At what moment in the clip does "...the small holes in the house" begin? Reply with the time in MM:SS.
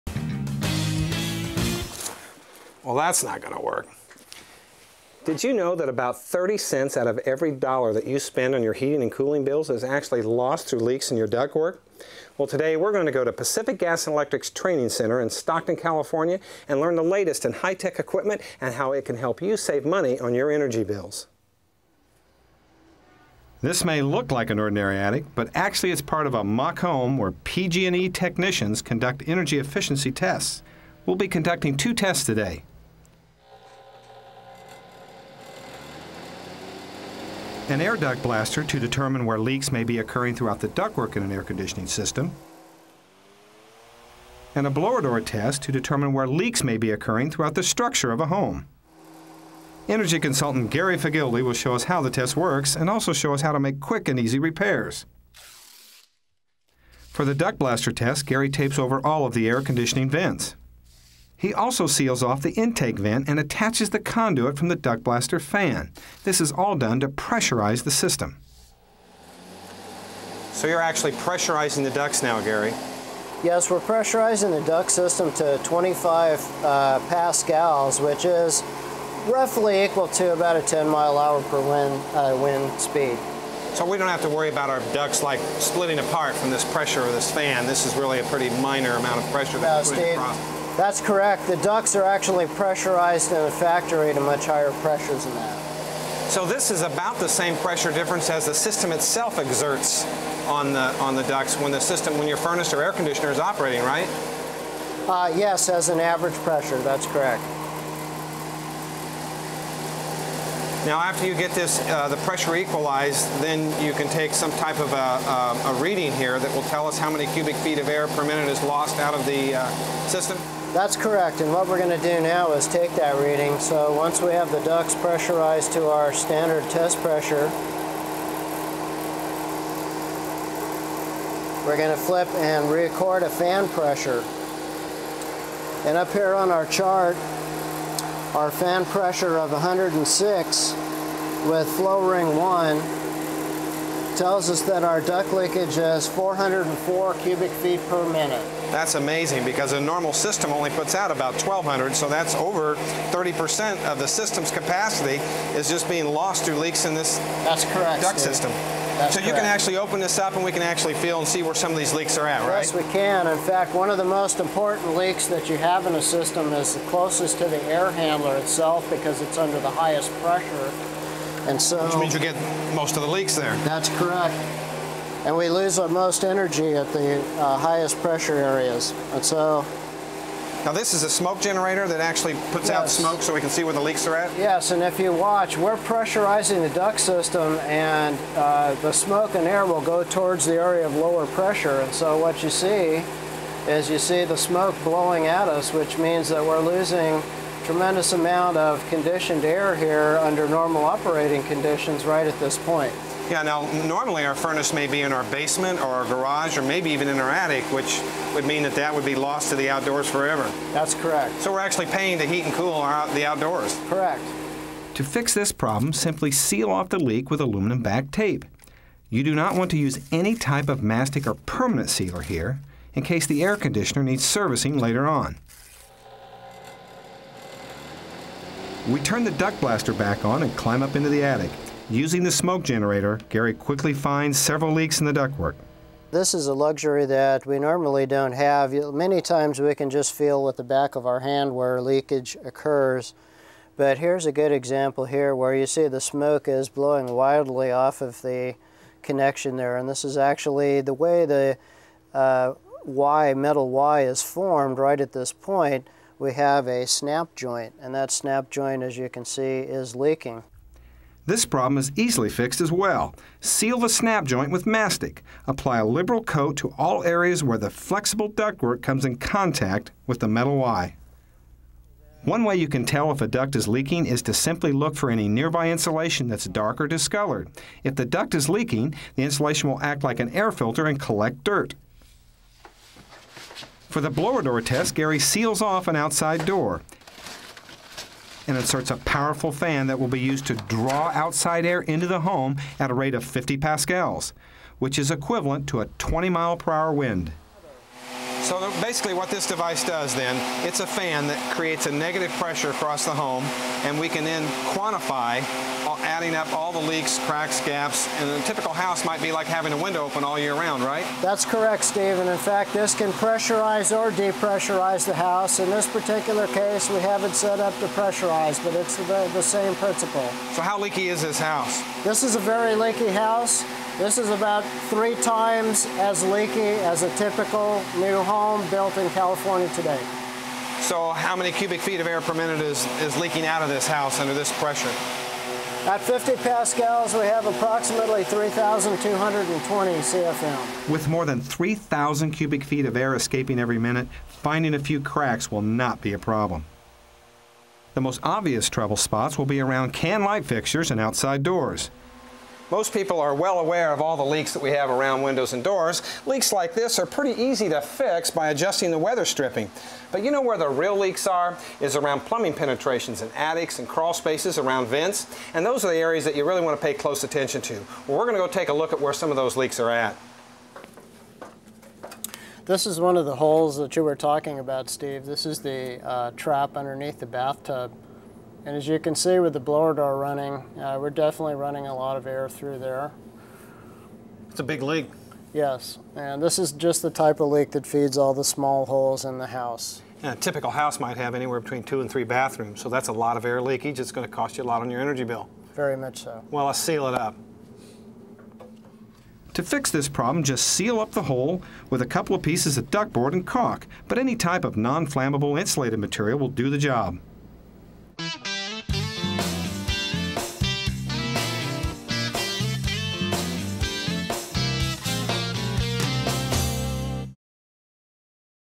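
06:28.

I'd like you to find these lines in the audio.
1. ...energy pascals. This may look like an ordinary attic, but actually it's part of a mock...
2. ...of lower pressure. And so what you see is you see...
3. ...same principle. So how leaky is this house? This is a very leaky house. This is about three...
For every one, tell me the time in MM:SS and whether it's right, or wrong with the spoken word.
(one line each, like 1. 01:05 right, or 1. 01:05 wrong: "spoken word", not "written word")
1. 00:20 wrong: "bills", not "pascals"
2. 03:10 right
3. 05:19 right.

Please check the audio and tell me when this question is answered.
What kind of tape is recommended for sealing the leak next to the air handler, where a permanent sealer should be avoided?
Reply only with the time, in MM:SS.
03:37.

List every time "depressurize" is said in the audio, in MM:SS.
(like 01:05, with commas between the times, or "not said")
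05:14.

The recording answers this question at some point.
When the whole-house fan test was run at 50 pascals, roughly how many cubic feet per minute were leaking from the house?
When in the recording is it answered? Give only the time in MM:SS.
05:38.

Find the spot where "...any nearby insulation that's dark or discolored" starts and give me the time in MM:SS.
04:35.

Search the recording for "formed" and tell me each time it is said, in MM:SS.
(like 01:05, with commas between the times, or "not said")
04:14.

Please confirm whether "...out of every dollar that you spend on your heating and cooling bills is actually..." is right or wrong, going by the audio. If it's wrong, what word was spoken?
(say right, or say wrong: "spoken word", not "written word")
right.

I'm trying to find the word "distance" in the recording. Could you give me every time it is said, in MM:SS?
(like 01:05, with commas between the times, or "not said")
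not said.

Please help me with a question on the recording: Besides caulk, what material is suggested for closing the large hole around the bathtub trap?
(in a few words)
Ductboard.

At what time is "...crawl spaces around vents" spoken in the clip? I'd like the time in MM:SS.
06:03.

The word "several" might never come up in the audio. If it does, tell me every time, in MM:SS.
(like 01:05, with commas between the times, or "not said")
03:54.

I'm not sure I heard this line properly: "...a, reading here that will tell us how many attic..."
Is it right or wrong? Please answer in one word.
wrong.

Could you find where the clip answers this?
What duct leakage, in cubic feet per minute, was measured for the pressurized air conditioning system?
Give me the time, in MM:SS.
02:26.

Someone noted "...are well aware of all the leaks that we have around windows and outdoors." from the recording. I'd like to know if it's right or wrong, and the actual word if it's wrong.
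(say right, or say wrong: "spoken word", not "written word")
wrong: "doors", not "outdoors".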